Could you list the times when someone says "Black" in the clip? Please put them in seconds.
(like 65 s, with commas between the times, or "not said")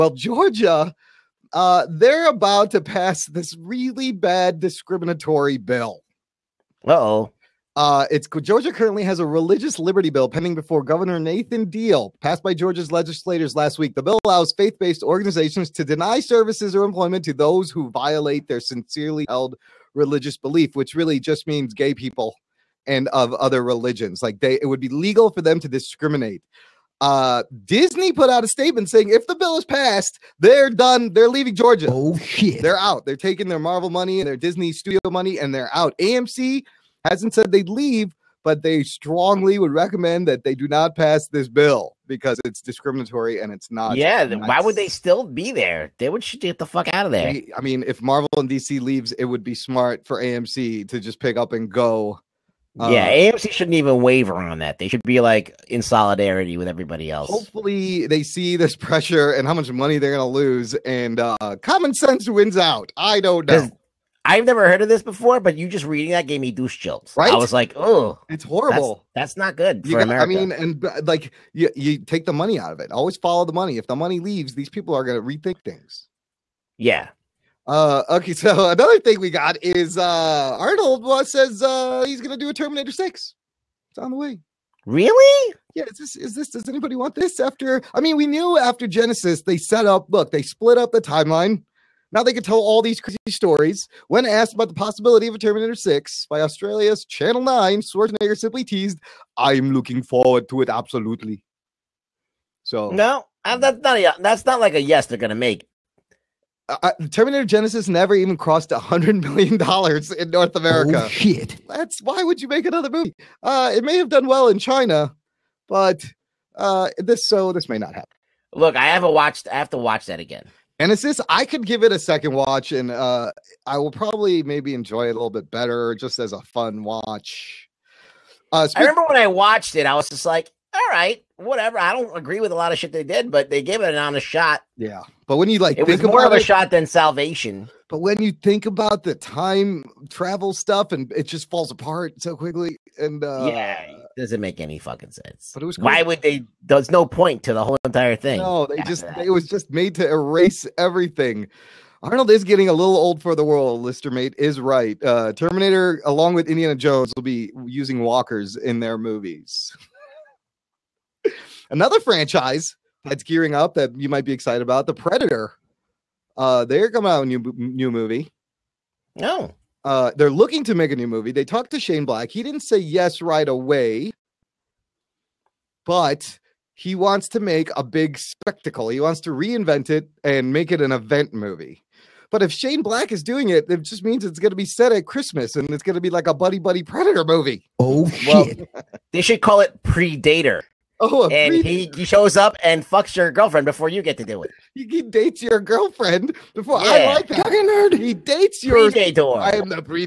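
172 s, 182 s.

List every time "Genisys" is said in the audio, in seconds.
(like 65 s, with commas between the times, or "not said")
88 s, 107 s.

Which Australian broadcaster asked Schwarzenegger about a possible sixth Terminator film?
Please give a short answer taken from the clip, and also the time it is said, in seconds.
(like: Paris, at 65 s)
Channel 9, at 97 s.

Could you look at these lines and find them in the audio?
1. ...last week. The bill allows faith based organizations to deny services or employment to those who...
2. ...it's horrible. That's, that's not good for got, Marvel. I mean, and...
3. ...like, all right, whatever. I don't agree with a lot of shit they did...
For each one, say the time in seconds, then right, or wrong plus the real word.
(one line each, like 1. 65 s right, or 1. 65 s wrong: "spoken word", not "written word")
1. 13 s right
2. 68 s wrong: "America", not "Marvel"
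3. 130 s right.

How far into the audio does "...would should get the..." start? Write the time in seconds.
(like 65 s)
46 s.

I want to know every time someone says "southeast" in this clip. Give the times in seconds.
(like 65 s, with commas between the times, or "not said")
not said.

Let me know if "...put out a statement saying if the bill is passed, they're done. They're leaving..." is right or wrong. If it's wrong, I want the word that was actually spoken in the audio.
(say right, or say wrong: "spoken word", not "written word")
right.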